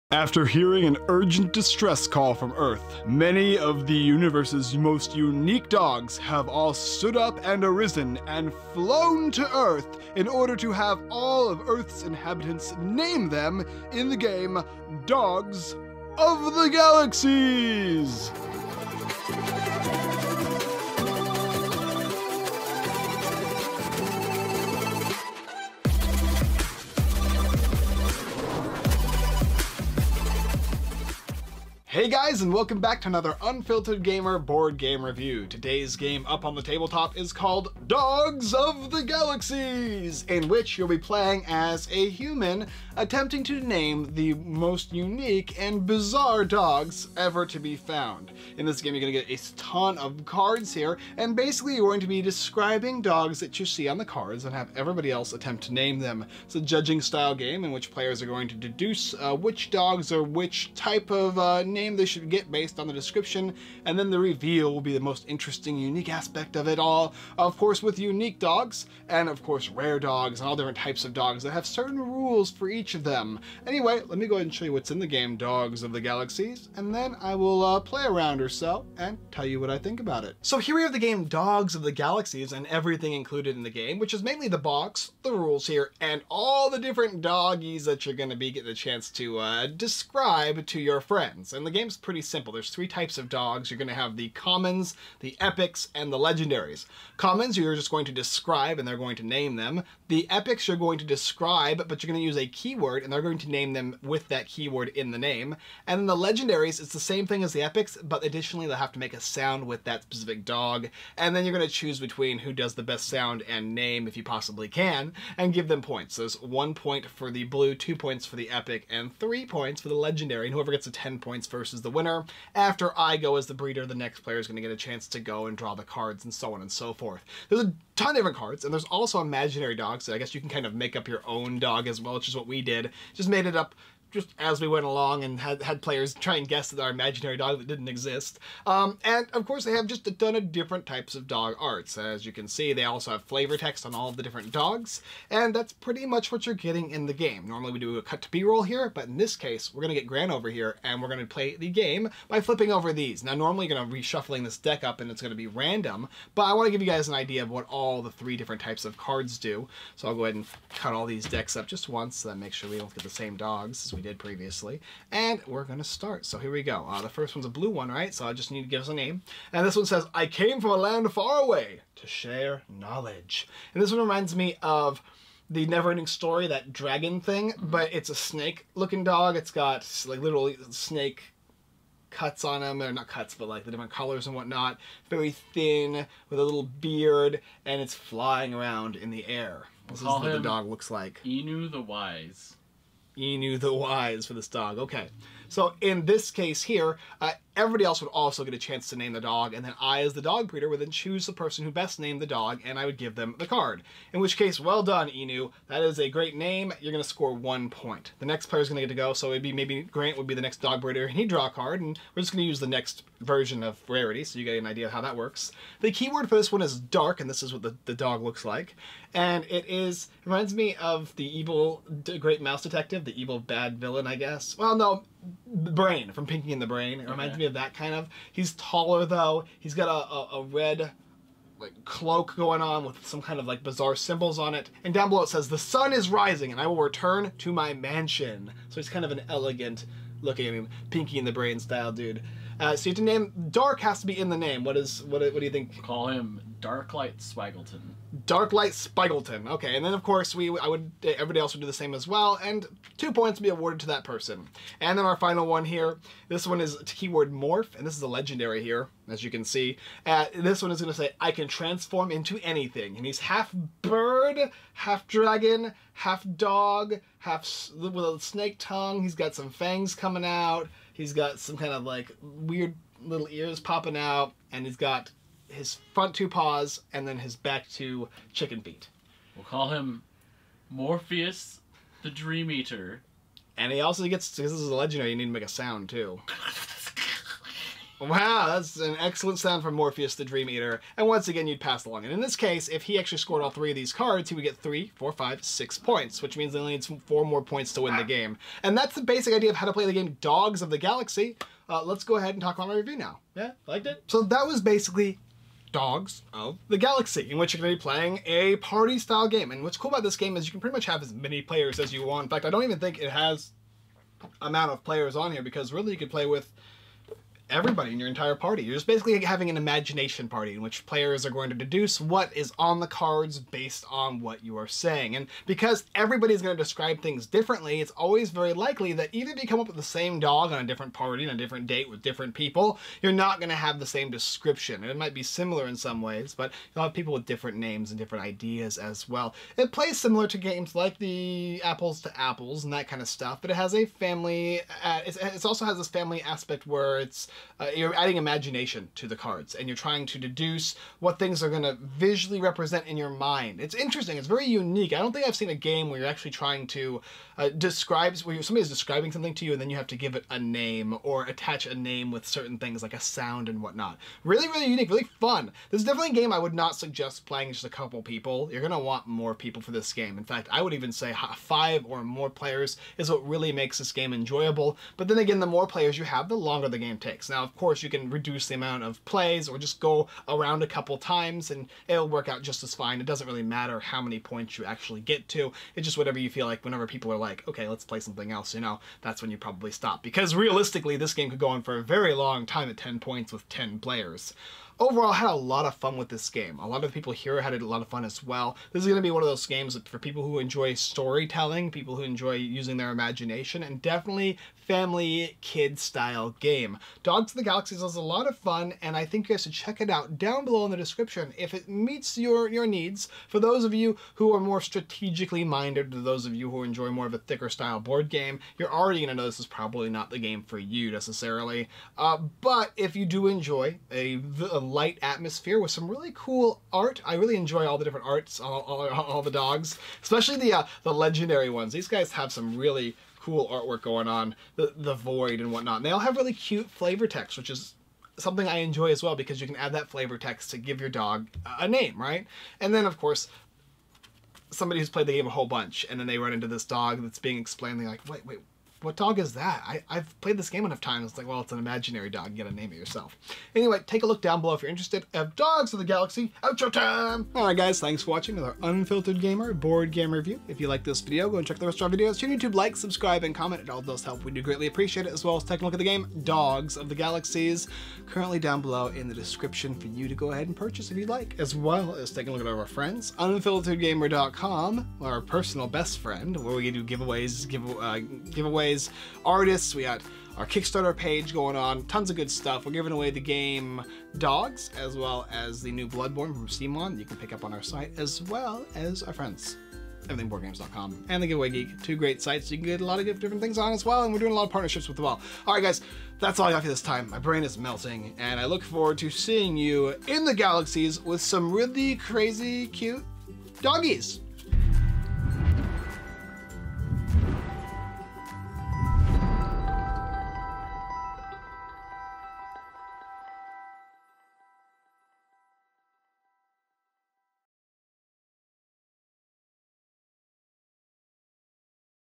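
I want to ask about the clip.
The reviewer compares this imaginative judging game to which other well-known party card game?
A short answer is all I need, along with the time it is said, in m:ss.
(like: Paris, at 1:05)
Apples to Apples, at 5:41.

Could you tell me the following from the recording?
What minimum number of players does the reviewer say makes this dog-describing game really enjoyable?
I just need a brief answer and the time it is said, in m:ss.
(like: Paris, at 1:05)
5, at 6:11.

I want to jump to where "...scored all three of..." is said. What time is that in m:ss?
4:53.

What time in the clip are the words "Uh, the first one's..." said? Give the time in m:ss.
2:46.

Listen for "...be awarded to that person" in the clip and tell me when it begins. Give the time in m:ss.
4:13.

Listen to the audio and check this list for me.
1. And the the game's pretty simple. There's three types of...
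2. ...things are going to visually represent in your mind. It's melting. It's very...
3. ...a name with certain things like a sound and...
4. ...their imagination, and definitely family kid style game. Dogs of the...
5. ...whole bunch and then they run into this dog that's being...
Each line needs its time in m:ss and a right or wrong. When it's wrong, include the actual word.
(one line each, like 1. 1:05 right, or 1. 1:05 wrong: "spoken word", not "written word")
1. 1:31 right
2. 5:51 wrong: "interesting", not "melting"
3. 6:01 right
4. 6:42 right
5. 7:25 right.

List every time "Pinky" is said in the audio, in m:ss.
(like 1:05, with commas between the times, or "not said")
3:46, 4:00.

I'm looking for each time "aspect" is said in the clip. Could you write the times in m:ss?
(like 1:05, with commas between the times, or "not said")
1:06, 5:46.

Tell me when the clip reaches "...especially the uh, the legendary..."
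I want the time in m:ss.
7:10.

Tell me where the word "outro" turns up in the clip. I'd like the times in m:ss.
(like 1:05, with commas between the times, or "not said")
7:36.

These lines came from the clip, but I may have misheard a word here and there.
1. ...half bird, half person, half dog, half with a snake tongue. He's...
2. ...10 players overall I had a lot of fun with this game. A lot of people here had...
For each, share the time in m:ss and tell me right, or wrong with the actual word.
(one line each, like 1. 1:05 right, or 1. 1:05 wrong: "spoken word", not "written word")
1. 4:23 wrong: "dragon", not "person"
2. 6:33 right.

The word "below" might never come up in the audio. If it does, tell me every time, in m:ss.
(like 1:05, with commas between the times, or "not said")
3:55, 6:50, 7:34, 7:48.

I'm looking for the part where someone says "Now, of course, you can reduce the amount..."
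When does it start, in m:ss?
6:17.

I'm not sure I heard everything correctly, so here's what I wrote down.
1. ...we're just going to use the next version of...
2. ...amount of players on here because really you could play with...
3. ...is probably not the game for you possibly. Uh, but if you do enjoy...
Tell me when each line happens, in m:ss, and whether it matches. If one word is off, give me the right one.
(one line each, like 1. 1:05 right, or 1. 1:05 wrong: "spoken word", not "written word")
1. 3:32 right
2. 5:14 right
3. 6:59 wrong: "necessarily", not "possibly".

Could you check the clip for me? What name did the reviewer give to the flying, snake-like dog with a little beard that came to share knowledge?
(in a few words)
Inu the Wise.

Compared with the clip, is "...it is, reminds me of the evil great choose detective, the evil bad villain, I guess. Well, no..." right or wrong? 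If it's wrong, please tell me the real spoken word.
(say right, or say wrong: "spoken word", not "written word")
wrong: "mouse", not "choose".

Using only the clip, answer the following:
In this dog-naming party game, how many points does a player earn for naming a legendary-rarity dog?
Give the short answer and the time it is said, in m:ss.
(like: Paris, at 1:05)
3, at 1:59.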